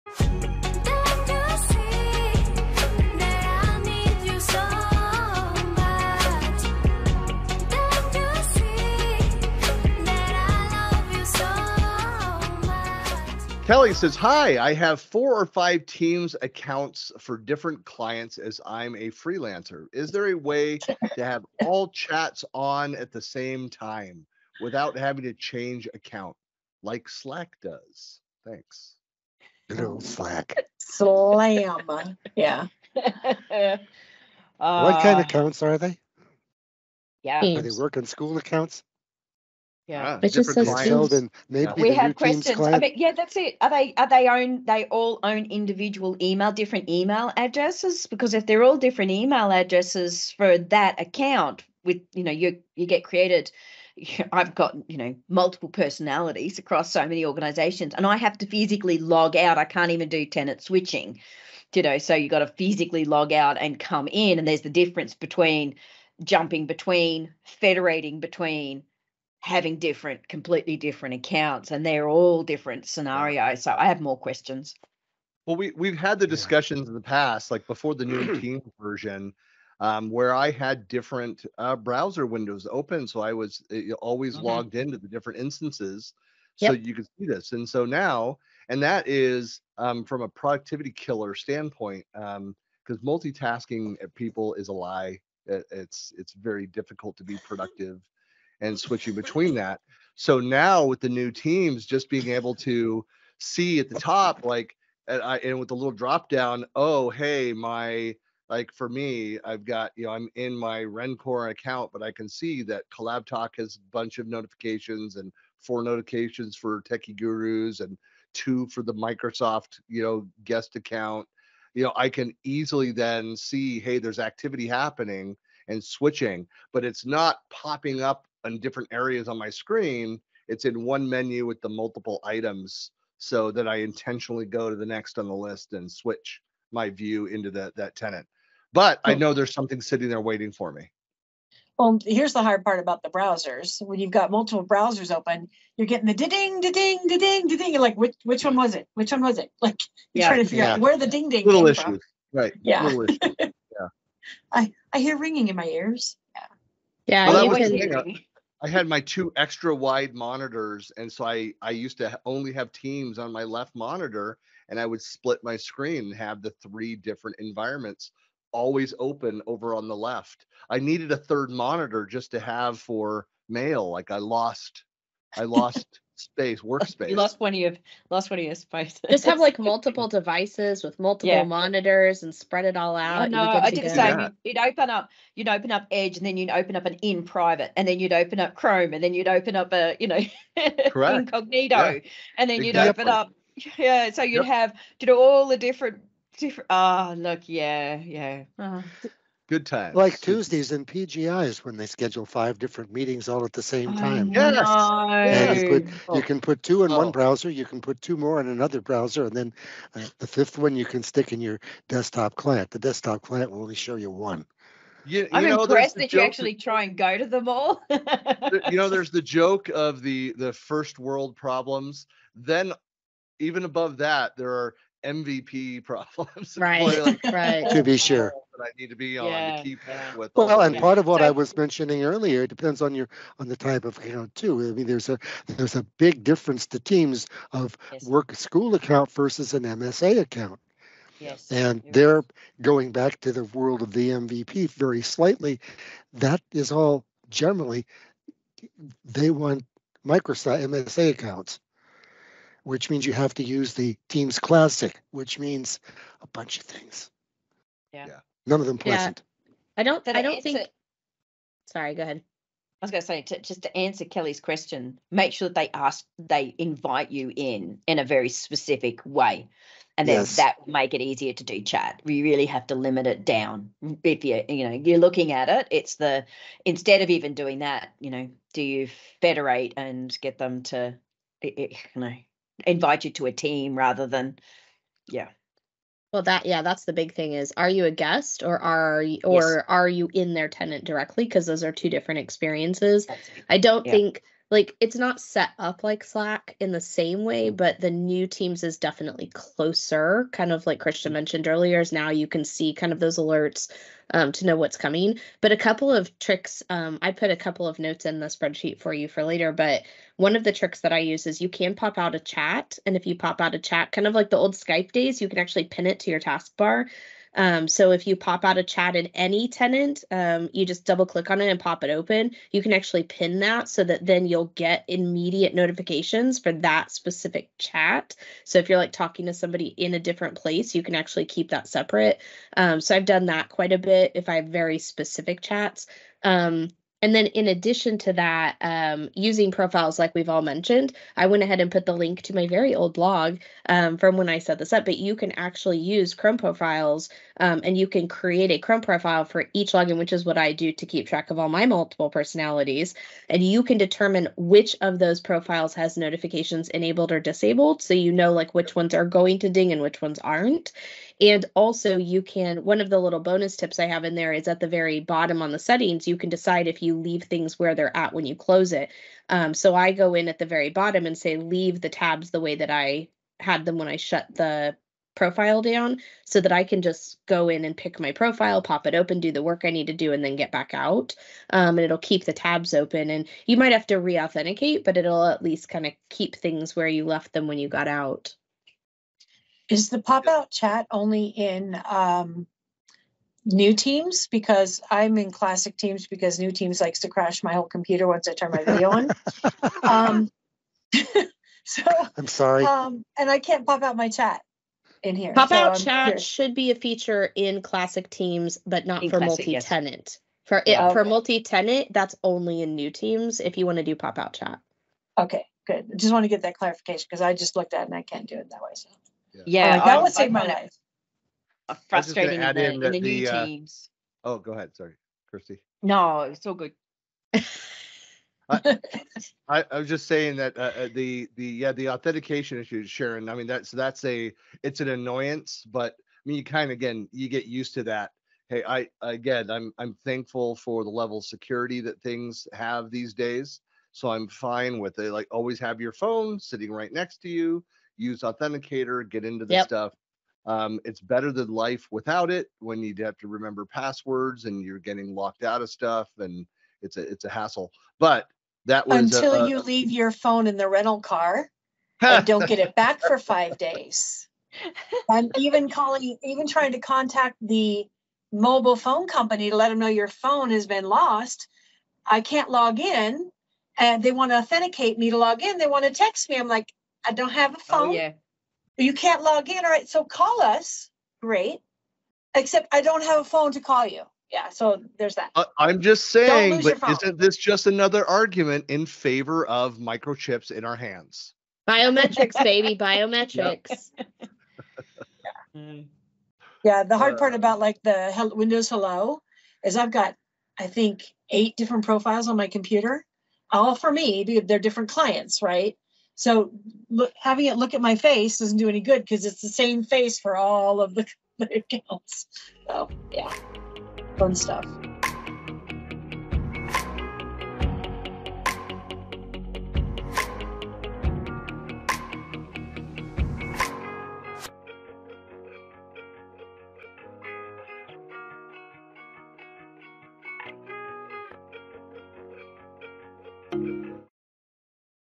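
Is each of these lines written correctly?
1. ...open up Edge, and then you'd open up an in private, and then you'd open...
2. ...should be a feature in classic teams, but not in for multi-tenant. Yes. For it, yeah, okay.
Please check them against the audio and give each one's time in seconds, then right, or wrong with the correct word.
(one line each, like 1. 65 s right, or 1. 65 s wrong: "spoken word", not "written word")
1. 185 s right
2. 406 s right.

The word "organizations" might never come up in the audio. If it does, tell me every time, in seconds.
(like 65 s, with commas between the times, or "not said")
57 s.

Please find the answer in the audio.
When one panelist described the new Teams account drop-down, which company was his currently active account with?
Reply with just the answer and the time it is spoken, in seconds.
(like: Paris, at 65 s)
Rencore, at 110 s.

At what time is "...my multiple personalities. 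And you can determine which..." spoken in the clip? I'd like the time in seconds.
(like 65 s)
351 s.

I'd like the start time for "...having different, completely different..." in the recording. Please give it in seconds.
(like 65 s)
69 s.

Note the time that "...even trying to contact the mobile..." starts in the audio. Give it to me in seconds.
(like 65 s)
466 s.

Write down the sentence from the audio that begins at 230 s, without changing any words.
Well, and part of what I was mentioning earlier, it depends on your on the type of account too.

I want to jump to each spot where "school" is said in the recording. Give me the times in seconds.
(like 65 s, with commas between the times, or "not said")
38 s, 238 s.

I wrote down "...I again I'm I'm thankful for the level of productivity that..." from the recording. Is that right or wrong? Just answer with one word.
wrong.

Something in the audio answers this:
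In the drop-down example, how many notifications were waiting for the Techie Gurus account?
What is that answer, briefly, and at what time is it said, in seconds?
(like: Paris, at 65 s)
4, at 115 s.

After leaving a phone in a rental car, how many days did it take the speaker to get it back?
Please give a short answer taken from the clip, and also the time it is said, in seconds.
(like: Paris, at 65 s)
5, at 463 s.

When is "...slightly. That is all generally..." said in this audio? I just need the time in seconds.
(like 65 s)
245 s.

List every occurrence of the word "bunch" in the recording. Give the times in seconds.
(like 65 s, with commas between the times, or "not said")
113 s, 256 s.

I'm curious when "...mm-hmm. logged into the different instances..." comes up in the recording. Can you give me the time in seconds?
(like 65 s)
84 s.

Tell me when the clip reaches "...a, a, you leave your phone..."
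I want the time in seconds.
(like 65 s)
459 s.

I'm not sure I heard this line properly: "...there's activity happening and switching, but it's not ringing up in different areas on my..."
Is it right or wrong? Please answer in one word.
wrong.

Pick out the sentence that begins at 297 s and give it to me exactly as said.
but the new Teams is definitely closer.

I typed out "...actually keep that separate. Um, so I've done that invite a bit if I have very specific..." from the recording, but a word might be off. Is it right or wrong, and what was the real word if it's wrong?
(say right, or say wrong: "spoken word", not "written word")
wrong: "quite", not "invite".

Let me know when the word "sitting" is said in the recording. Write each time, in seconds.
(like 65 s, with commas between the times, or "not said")
139 s, 446 s.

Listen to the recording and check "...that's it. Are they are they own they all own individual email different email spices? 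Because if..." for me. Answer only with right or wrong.
wrong.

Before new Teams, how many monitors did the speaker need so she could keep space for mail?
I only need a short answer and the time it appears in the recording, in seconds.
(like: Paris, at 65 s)
3, at 171 s.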